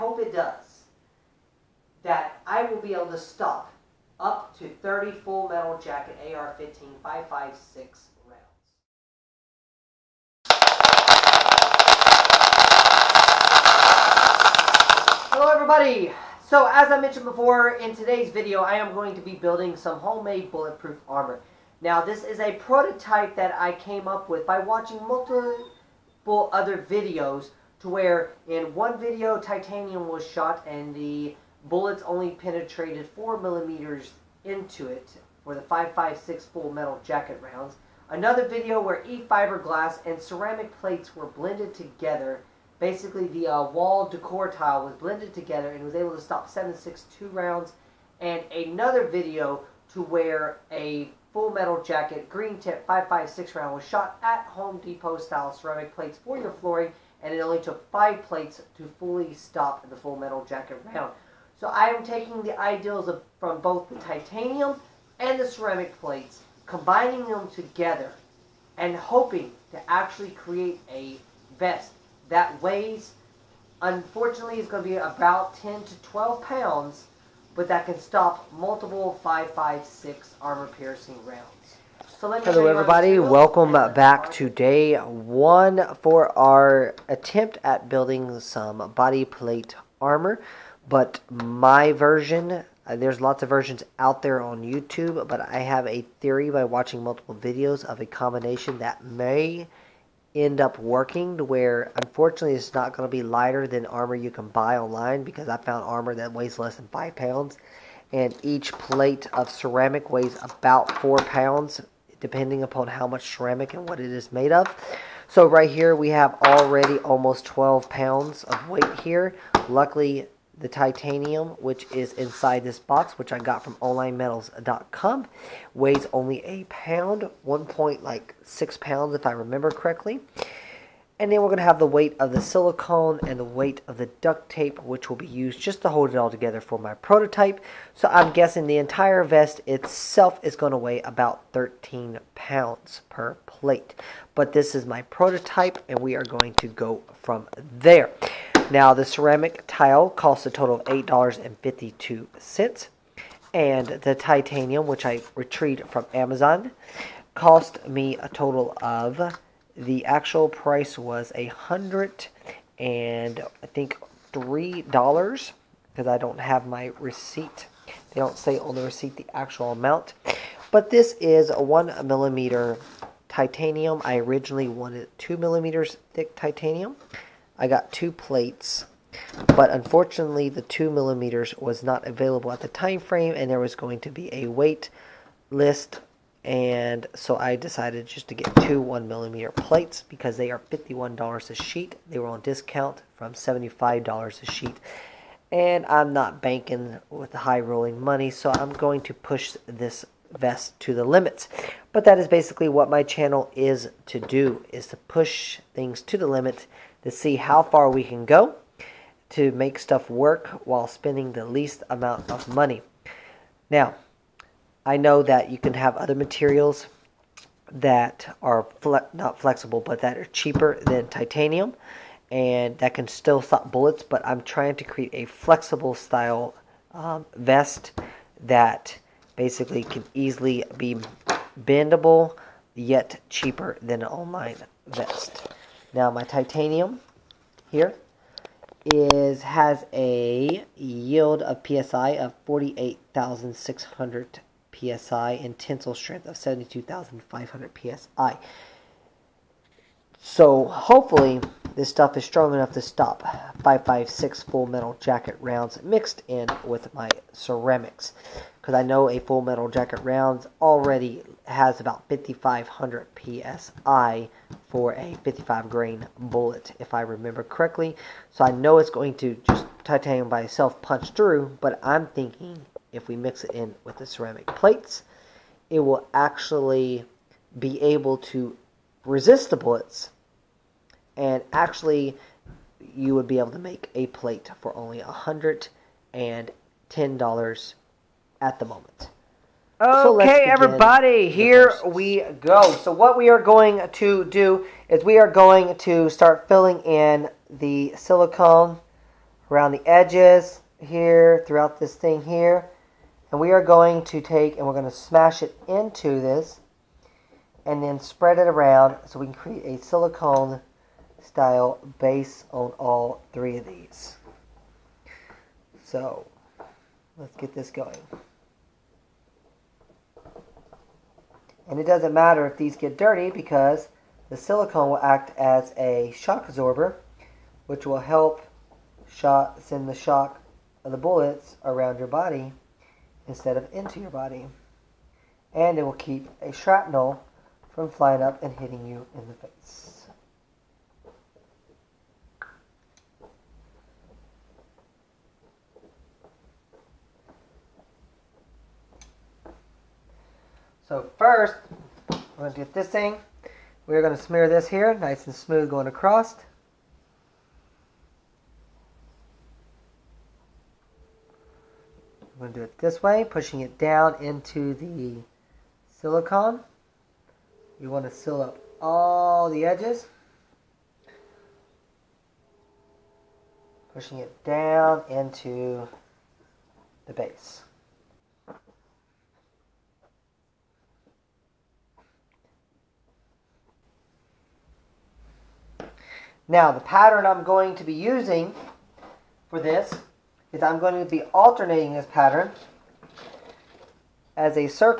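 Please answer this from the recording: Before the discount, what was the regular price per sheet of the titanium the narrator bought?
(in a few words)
$75.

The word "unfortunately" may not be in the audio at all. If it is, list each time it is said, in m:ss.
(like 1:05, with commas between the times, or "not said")
1:13, 1:41, 2:59.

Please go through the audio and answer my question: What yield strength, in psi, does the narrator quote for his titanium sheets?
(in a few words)
48,600 psi.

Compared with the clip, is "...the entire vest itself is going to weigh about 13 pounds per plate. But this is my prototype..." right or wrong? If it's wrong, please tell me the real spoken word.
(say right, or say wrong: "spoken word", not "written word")
right.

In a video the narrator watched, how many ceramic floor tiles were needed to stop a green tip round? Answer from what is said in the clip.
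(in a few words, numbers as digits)
5.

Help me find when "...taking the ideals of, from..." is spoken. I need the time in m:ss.
1:02.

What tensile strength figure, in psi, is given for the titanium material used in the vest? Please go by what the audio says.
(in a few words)
72,500 psi.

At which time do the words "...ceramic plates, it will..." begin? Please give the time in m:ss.
4:34.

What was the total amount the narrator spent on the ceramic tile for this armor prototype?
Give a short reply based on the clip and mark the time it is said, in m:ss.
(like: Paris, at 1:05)
$8.52, at 2:30.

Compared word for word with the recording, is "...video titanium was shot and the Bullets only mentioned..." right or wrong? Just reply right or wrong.
wrong.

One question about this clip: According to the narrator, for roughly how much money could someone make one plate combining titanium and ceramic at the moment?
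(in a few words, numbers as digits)
$110.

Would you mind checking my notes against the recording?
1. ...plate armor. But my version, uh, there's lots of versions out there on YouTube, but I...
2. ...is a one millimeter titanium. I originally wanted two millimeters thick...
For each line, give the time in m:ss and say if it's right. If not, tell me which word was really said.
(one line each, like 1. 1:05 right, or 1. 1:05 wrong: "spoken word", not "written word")
1. 1:29 right
2. 2:51 right.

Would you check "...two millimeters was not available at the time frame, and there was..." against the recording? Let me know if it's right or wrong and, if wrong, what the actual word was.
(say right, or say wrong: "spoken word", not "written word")
right.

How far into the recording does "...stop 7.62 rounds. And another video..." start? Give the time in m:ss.
0:46.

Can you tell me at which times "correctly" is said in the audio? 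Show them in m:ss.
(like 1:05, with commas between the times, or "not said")
2:09, 4:27.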